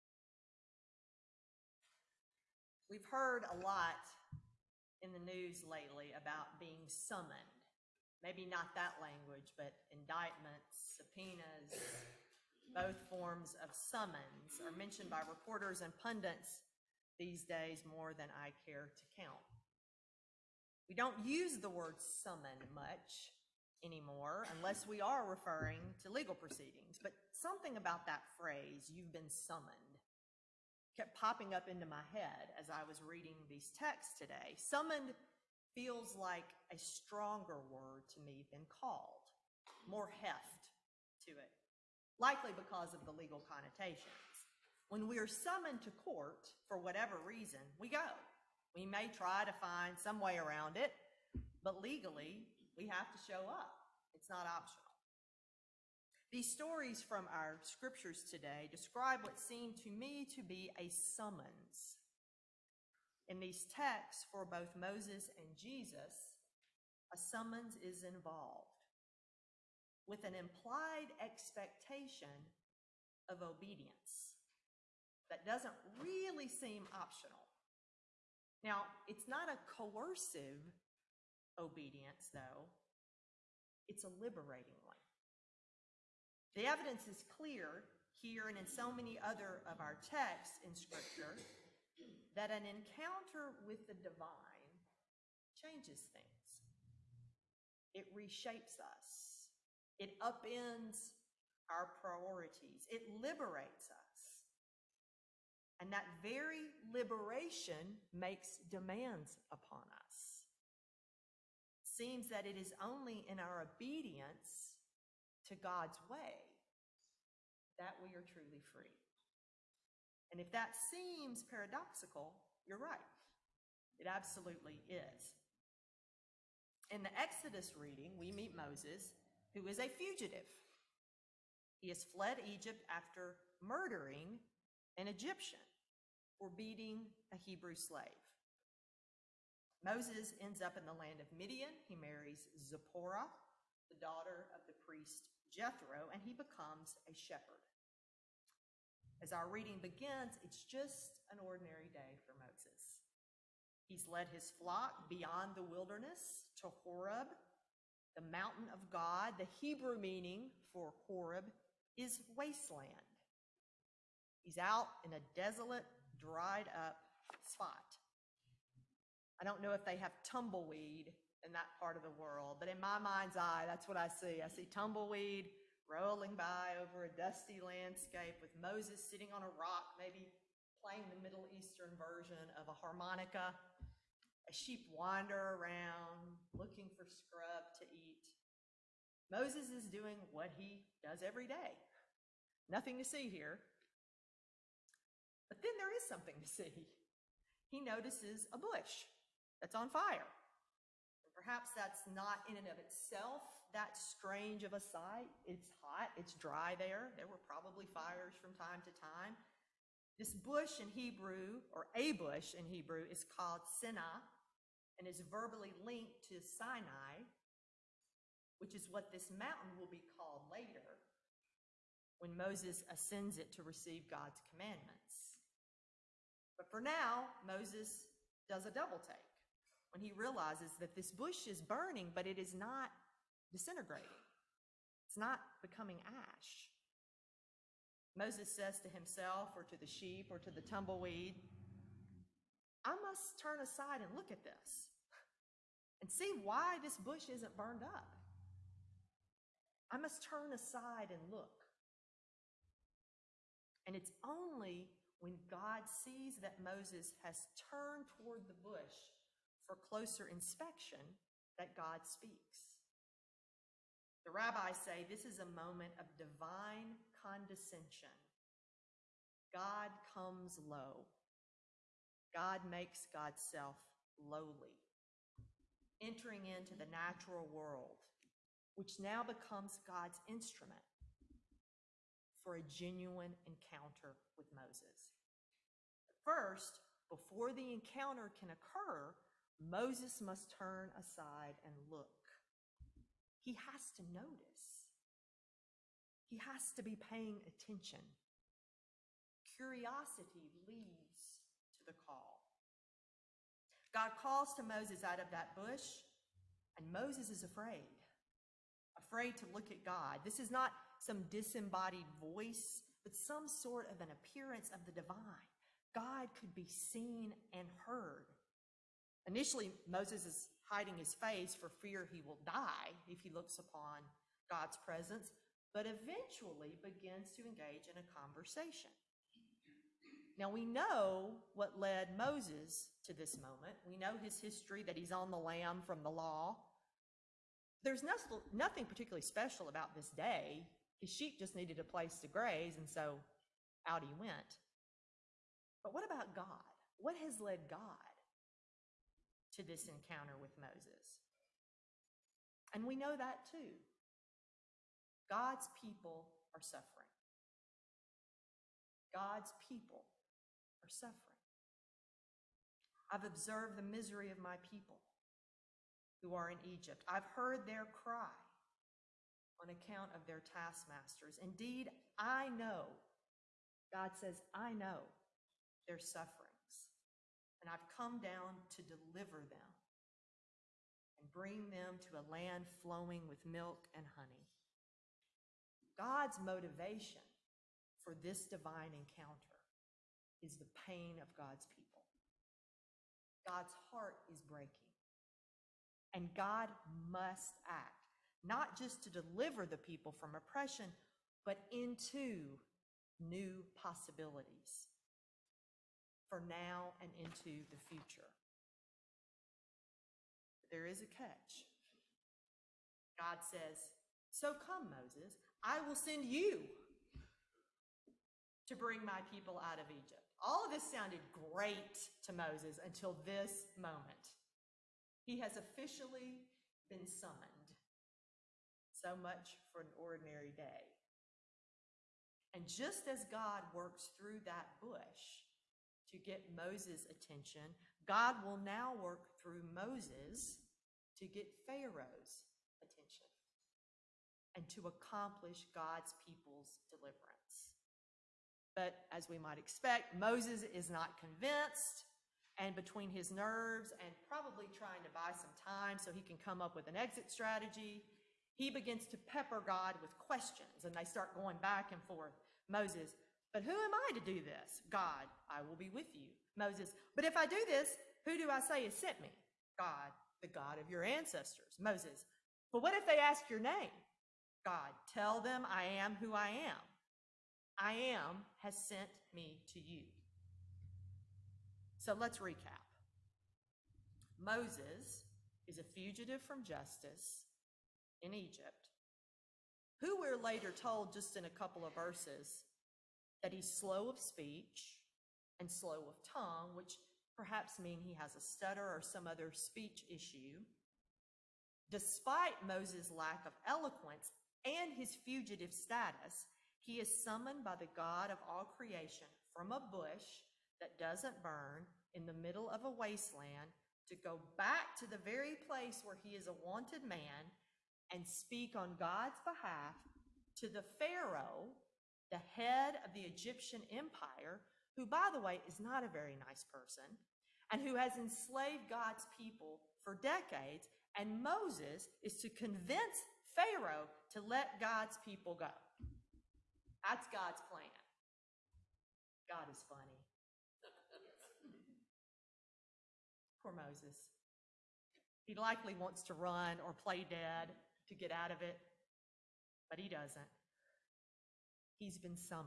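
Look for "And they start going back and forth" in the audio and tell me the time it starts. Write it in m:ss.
7:40.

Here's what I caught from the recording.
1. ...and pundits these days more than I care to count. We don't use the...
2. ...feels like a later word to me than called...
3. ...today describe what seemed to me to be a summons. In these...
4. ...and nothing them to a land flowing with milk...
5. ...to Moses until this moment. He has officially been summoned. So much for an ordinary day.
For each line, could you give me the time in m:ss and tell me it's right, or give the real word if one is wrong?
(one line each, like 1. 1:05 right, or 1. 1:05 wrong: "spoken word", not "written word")
1. 0:15 right
2. 0:35 wrong: "stronger", not "later"
3. 0:58 right
4. 6:21 wrong: "bring", not "nothing"
5. 7:02 right.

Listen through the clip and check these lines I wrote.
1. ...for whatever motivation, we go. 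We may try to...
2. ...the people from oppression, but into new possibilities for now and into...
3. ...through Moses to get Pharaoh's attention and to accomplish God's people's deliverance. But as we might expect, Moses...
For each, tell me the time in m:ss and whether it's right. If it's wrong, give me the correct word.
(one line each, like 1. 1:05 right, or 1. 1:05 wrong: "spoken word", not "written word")
1. 0:46 wrong: "reason", not "motivation"
2. 6:39 right
3. 7:19 right.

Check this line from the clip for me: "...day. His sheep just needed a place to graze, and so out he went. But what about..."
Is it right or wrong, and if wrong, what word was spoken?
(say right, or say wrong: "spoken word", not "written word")
right.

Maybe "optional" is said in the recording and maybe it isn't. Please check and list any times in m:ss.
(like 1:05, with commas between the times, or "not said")
0:54, 1:16.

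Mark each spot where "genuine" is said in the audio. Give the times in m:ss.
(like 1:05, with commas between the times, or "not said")
4:42.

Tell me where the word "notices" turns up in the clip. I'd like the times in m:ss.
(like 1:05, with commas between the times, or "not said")
3:17, 4:54.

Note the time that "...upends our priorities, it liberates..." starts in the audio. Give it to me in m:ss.
1:40.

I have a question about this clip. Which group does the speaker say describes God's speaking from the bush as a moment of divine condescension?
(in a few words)
The rabbis.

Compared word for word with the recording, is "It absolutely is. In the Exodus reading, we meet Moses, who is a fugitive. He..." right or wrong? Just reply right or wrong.
right.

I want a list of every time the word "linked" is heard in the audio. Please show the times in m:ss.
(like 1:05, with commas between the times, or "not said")
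3:35.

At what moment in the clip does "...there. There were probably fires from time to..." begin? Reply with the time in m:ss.
3:26.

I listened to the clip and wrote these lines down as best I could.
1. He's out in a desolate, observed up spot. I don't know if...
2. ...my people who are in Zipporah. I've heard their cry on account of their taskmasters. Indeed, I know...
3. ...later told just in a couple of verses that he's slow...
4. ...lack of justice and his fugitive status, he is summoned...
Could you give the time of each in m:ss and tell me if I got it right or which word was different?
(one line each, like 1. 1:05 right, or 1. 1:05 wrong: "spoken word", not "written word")
1. 2:44 wrong: "dried", not "observed"
2. 6:04 wrong: "Egypt", not "Zipporah"
3. 8:10 right
4. 8:23 wrong: "eloquence", not "justice".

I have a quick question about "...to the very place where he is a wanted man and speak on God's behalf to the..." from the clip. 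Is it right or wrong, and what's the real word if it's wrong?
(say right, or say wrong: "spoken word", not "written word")
right.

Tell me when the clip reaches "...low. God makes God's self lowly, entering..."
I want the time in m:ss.
4:30.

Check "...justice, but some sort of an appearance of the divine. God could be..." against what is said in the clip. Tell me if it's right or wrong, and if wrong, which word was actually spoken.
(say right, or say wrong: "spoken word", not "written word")
wrong: "voice", not "justice".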